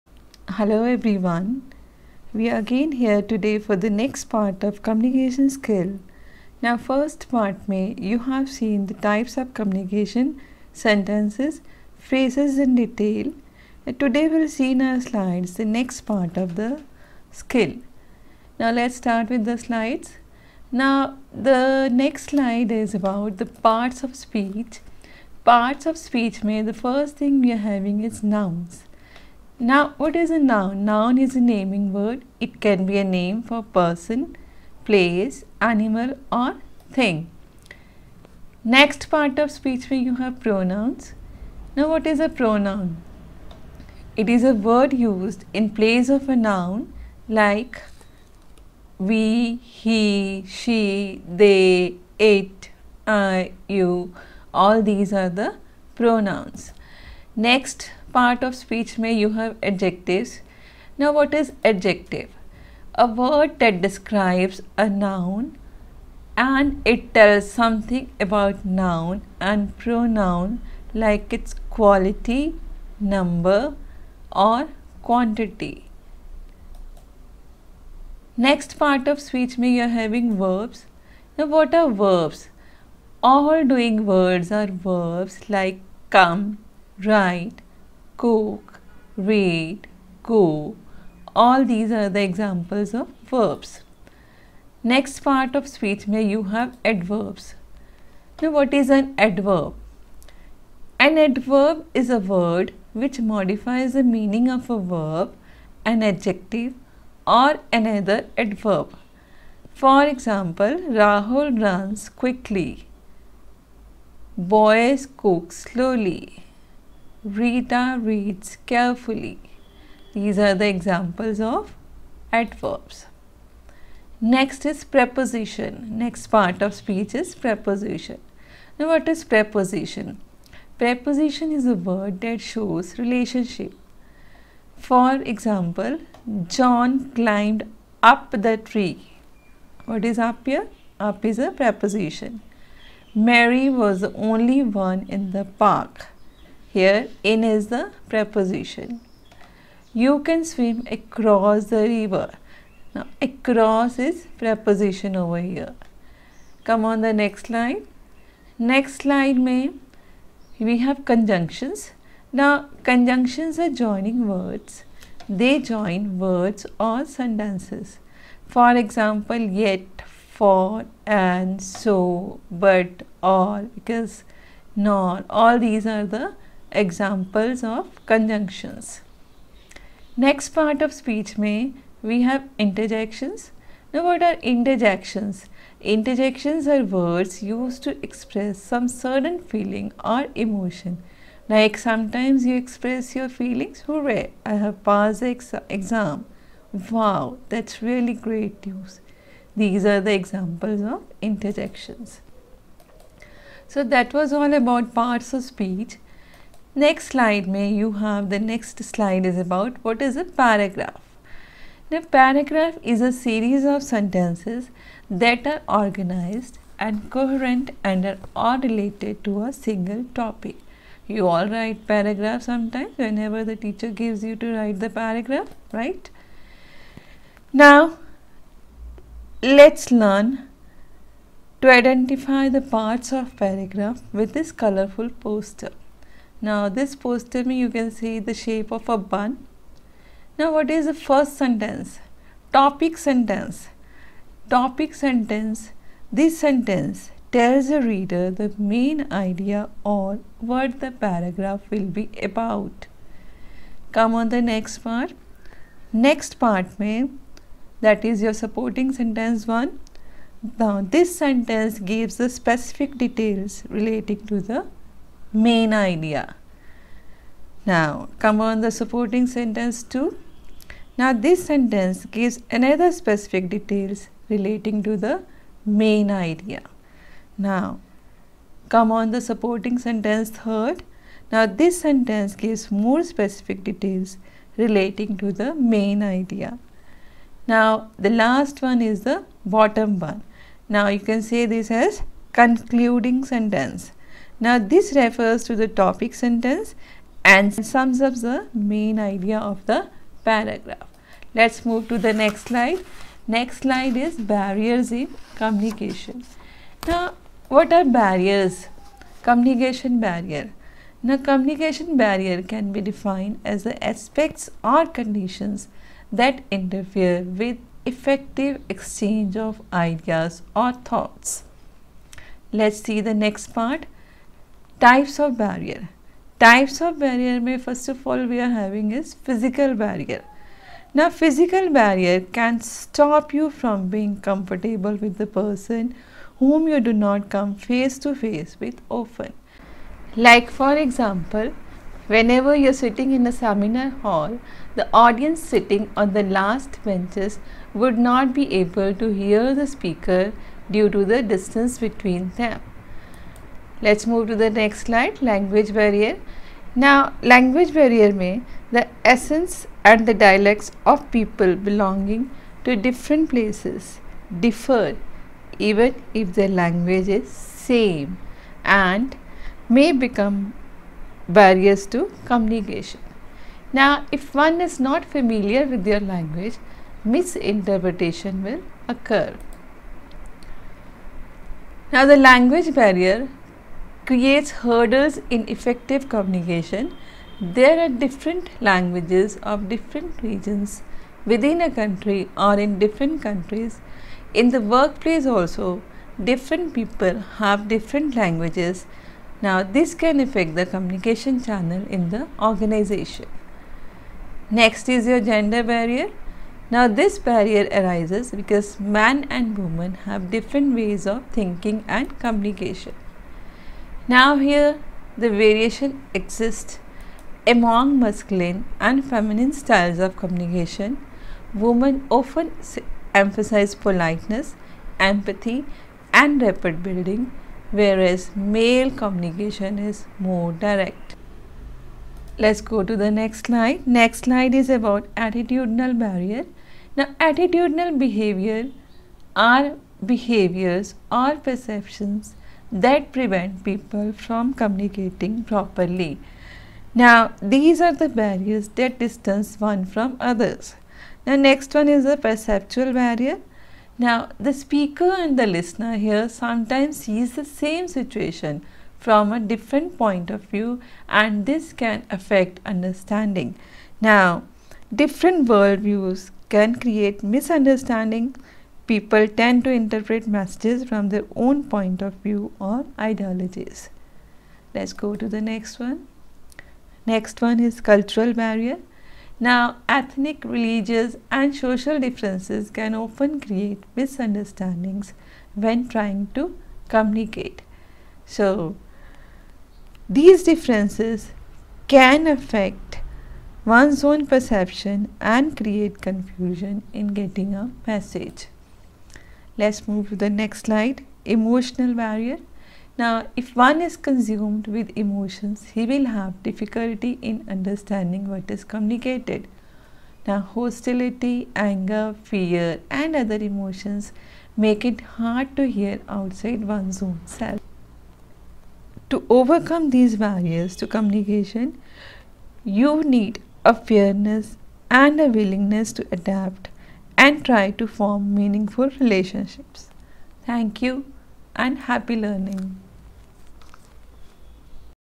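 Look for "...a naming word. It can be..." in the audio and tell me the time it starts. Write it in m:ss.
0:31.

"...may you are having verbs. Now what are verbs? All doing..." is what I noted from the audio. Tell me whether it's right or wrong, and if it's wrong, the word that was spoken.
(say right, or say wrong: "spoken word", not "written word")
right.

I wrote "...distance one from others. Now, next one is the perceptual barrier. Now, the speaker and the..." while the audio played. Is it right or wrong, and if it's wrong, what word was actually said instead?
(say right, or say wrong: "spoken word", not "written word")
right.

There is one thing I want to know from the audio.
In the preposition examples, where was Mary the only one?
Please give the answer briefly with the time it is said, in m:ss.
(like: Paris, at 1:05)
in the park, at 2:25.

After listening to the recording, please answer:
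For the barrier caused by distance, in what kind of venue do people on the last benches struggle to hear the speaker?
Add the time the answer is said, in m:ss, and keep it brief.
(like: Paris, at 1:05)
seminar hall, at 5:43.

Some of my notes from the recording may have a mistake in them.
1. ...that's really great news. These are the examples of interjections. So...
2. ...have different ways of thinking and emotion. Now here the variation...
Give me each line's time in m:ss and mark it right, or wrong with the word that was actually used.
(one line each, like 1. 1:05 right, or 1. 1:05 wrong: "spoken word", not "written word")
1. 3:17 right
2. 6:50 wrong: "communication", not "emotion".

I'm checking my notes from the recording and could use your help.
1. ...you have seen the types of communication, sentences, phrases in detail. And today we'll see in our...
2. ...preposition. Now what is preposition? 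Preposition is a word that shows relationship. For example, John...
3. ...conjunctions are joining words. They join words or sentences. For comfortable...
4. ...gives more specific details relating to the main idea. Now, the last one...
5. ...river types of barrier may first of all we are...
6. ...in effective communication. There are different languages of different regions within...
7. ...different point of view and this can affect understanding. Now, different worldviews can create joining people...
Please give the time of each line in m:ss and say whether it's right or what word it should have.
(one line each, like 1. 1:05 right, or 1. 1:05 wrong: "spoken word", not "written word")
1. 0:07 right
2. 2:07 right
3. 2:42 wrong: "example", not "comfortable"
4. 4:42 right
5. 5:25 wrong: "barrier", not "river"
6. 6:25 right
7. 7:39 wrong: "misunderstanding", not "joining".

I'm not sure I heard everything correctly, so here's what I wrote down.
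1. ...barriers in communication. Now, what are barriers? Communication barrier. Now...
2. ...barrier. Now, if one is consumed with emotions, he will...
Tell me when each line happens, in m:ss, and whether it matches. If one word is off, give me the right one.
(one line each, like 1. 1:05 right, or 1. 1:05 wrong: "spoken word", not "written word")
1. 5:04 right
2. 8:21 right.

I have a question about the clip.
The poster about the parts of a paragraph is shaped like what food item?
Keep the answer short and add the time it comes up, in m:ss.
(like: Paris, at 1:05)
a bun, at 3:58.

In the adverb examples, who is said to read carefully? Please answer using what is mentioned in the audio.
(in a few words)
Rita.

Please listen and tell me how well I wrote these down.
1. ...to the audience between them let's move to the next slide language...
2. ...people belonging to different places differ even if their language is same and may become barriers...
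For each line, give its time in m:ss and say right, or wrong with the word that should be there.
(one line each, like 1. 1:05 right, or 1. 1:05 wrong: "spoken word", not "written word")
1. 5:50 wrong: "distance", not "audience"
2. 6:01 right.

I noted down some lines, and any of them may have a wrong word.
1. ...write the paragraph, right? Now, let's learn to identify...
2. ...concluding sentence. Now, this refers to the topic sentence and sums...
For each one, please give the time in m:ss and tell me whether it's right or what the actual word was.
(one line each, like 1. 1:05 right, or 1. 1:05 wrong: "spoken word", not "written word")
1. 3:44 right
2. 4:52 right.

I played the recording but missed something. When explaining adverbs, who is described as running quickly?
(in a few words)
Rahul.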